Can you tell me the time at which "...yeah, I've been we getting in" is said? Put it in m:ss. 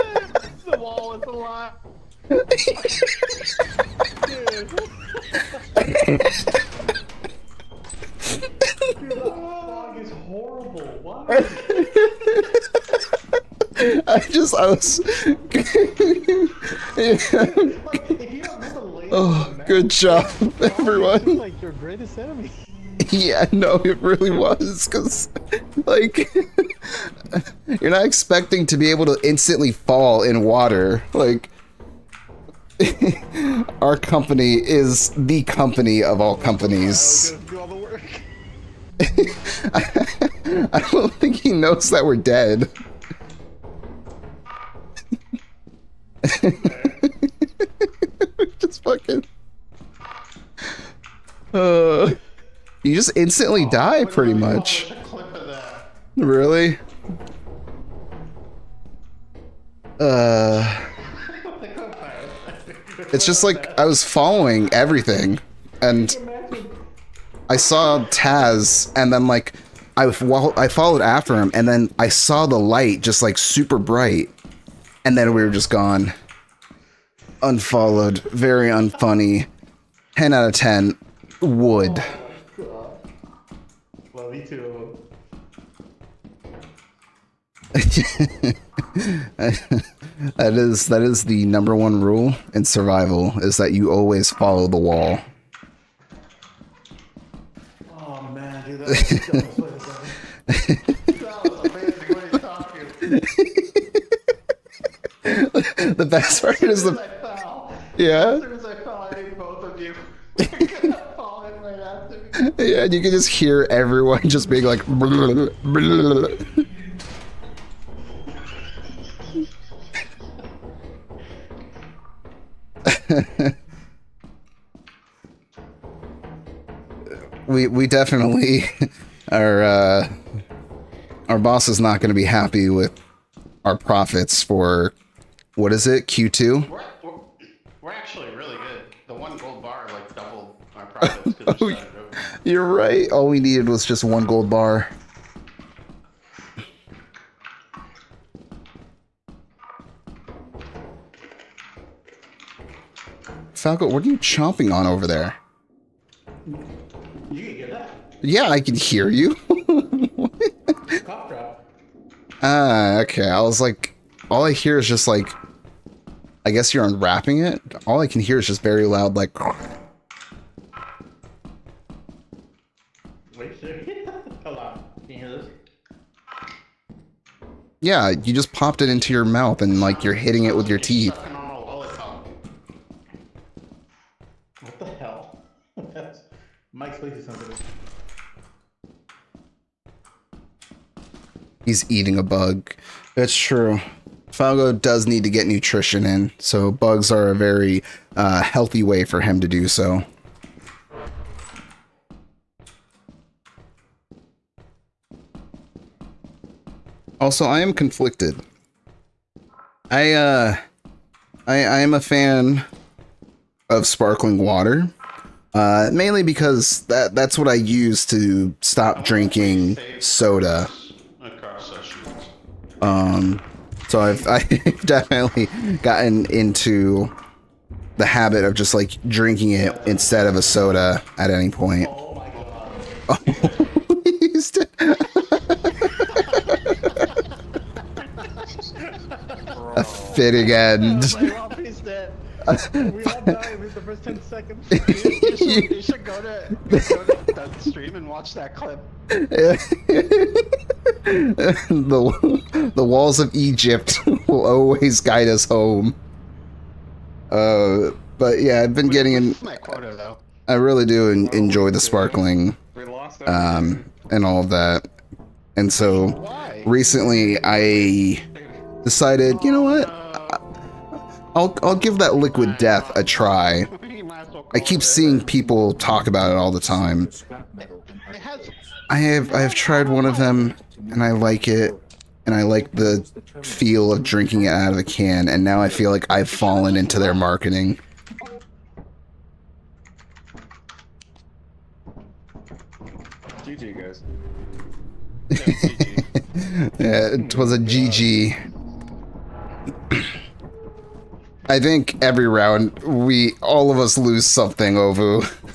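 4:18.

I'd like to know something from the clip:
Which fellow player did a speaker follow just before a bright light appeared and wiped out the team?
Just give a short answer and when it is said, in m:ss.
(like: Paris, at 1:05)
Taz, at 1:08.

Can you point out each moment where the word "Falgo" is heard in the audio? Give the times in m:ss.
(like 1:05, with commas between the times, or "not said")
2:33, 3:14.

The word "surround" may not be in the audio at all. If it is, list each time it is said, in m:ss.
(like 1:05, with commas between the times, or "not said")
not said.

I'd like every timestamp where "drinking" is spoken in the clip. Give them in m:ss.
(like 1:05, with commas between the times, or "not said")
3:39, 3:49, 4:44.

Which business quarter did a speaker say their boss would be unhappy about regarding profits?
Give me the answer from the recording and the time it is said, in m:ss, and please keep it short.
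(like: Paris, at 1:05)
Q2, at 2:16.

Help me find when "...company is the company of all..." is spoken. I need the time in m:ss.
0:33.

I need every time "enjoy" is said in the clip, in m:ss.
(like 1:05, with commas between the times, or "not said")
4:21.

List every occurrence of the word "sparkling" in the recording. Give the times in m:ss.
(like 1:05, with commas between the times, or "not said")
3:33, 4:21.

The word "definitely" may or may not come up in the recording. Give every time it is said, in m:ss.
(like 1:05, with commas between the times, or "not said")
2:07, 3:44.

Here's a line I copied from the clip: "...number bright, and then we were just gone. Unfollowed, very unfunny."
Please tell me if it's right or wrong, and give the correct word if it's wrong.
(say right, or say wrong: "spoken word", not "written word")
wrong: "super", not "number".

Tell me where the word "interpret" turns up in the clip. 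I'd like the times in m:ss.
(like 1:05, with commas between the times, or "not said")
not said.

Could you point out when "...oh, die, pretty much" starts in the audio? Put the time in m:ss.
0:53.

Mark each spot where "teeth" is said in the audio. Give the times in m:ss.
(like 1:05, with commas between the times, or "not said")
3:00.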